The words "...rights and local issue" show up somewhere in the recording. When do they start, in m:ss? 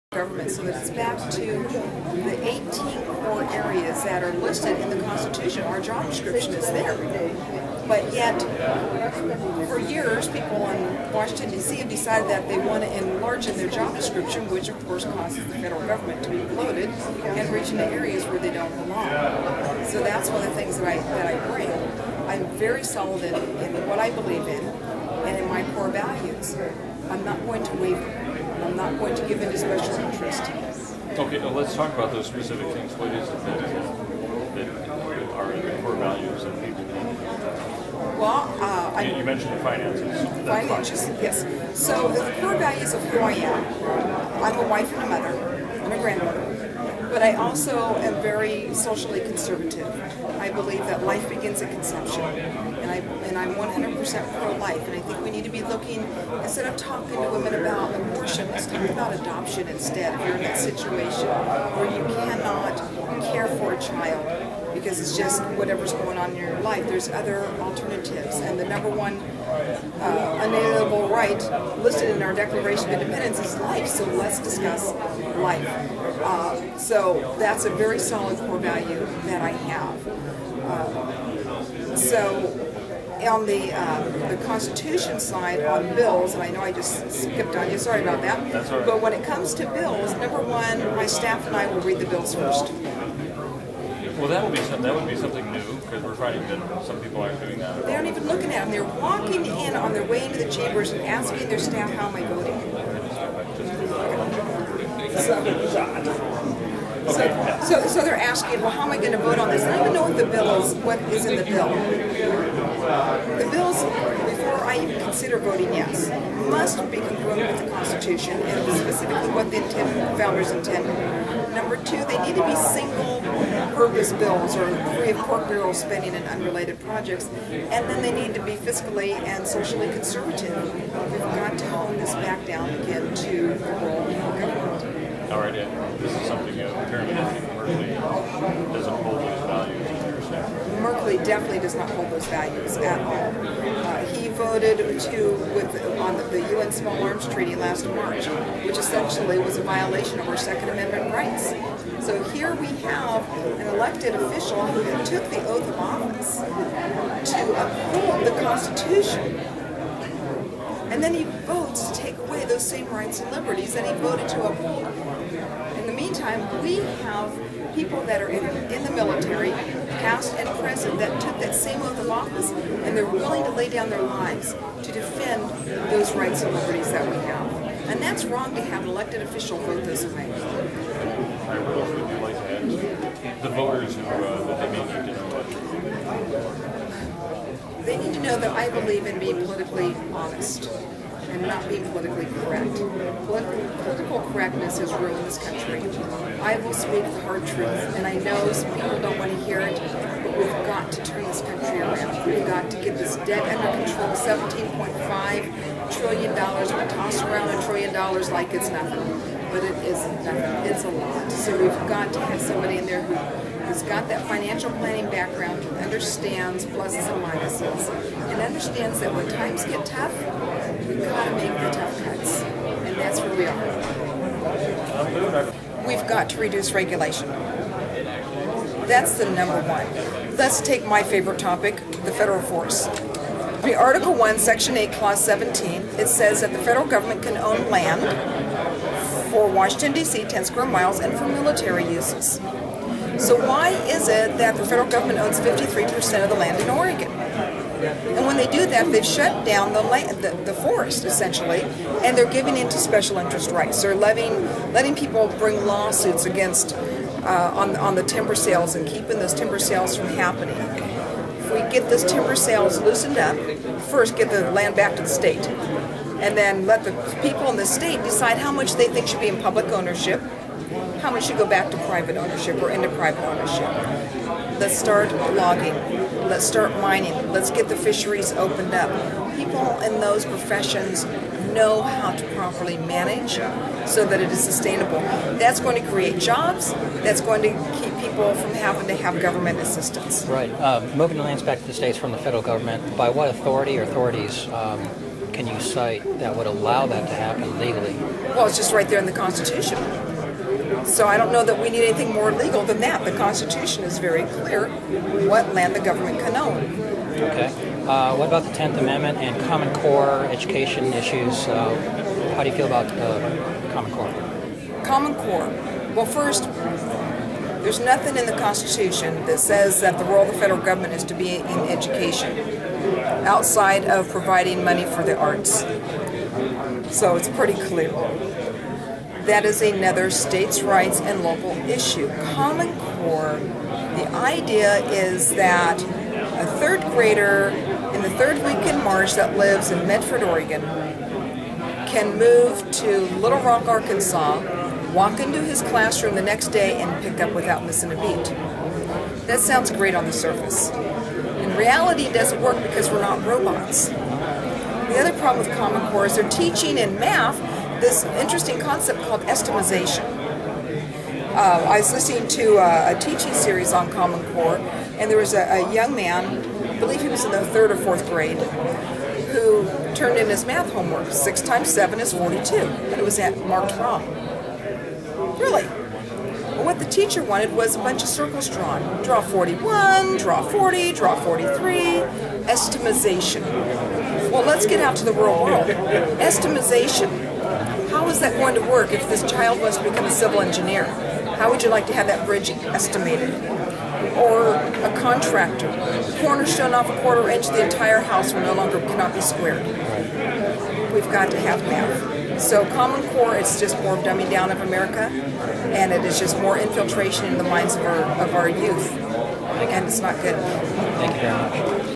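5:30.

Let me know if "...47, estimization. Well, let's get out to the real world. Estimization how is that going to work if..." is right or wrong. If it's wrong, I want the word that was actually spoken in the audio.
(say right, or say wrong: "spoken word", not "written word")
wrong: "43", not "47".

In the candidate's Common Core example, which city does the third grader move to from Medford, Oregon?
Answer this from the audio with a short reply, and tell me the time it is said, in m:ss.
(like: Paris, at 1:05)
Little Rock, Arkansas, at 5:43.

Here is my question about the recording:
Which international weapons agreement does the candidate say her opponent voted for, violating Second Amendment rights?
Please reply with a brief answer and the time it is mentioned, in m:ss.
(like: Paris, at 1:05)
UN Small Arms Treaty, at 2:26.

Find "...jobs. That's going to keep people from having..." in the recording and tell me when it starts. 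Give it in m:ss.
4:46.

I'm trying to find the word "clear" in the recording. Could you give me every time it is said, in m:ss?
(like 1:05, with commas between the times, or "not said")
5:04, 5:27.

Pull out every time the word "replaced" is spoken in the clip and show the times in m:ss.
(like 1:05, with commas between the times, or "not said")
not said.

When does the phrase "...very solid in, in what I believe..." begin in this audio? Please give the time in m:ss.
0:22.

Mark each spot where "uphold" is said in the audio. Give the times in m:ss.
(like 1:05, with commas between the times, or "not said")
2:37, 2:44.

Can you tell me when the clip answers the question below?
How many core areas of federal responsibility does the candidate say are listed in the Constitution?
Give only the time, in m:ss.
0:02.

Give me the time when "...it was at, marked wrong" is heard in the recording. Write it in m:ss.
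6:12.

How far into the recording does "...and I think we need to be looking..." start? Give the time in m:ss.
0:54.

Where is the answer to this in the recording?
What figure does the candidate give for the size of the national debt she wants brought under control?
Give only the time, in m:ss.
3:24.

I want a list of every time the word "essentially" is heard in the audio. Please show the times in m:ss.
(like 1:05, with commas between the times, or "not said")
2:28, 4:11.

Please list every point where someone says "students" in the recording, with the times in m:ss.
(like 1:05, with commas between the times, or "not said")
not said.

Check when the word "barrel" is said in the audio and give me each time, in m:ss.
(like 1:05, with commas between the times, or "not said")
2:05.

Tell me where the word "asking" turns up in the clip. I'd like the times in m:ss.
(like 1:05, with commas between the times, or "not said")
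1:41, 1:48.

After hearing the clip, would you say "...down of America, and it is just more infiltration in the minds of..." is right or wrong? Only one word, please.
right.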